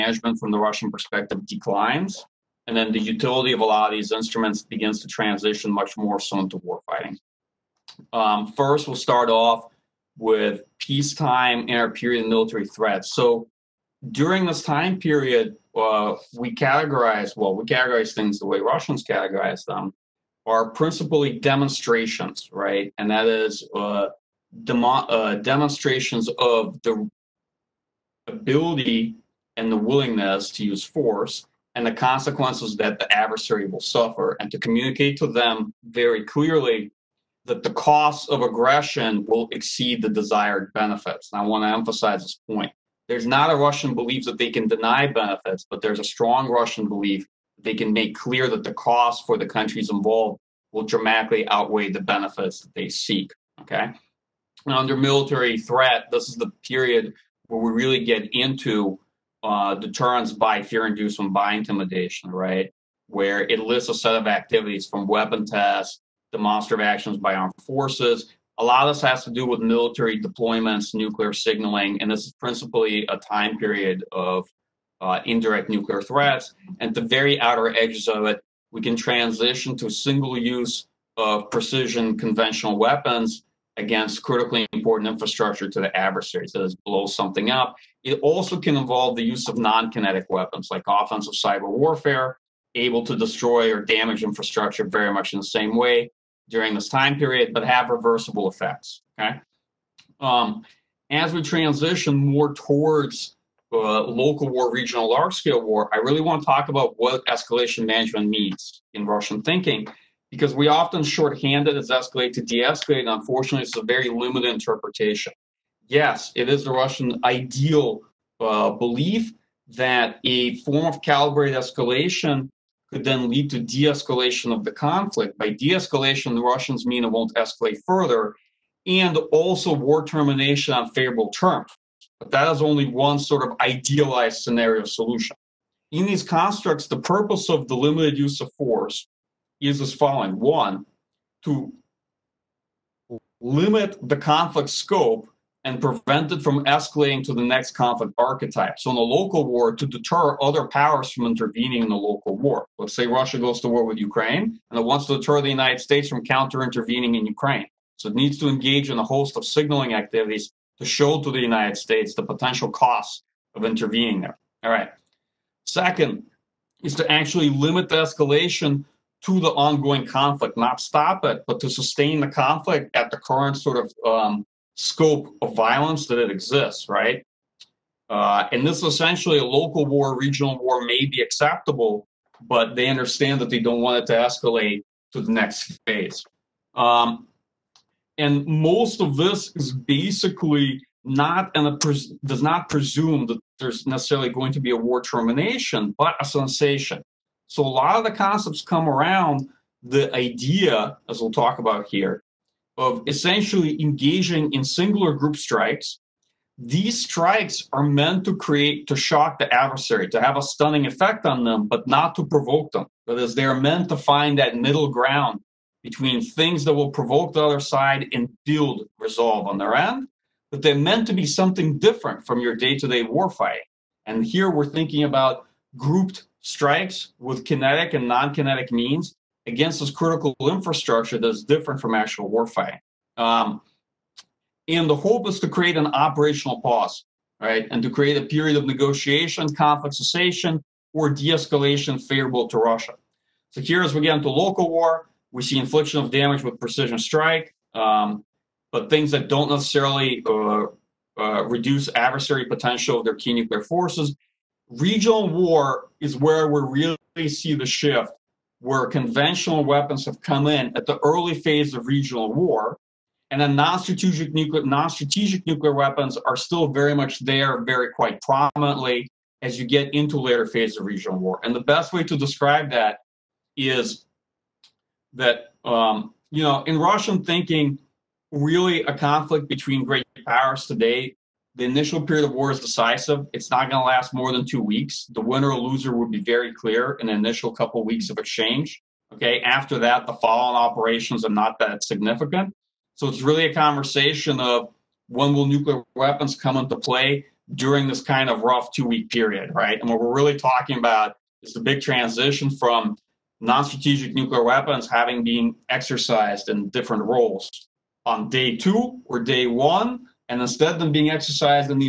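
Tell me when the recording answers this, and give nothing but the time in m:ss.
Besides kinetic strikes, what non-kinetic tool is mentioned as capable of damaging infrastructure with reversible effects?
1:30.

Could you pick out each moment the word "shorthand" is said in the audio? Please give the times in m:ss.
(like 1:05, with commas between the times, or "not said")
1:51.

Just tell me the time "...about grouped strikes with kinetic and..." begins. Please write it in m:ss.
3:45.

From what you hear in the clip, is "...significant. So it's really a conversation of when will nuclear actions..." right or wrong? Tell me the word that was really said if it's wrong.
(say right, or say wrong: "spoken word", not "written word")
wrong: "weapons", not "actions".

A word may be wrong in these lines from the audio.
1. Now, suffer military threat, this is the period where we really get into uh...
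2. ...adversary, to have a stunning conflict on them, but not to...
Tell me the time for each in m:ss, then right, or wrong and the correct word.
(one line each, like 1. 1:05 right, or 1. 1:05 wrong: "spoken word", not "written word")
1. 0:54 wrong: "under", not "suffer"
2. 3:29 wrong: "effect", not "conflict".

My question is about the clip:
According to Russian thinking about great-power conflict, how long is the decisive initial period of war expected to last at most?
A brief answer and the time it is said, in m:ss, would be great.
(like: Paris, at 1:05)
Two weeks, at 4:44.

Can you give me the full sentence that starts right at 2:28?
So, in a local war, to deter other powers from intervening in the local war.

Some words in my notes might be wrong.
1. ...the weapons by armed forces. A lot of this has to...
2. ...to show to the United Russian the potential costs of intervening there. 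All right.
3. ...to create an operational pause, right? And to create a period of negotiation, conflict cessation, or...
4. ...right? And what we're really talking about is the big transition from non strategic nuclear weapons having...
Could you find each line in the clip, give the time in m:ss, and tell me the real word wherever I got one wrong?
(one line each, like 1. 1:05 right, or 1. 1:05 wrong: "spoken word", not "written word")
1. 1:06 wrong: "actions", not "weapons"
2. 2:40 wrong: "States", not "Russian"
3. 3:55 right
4. 4:59 right.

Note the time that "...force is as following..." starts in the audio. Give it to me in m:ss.
2:18.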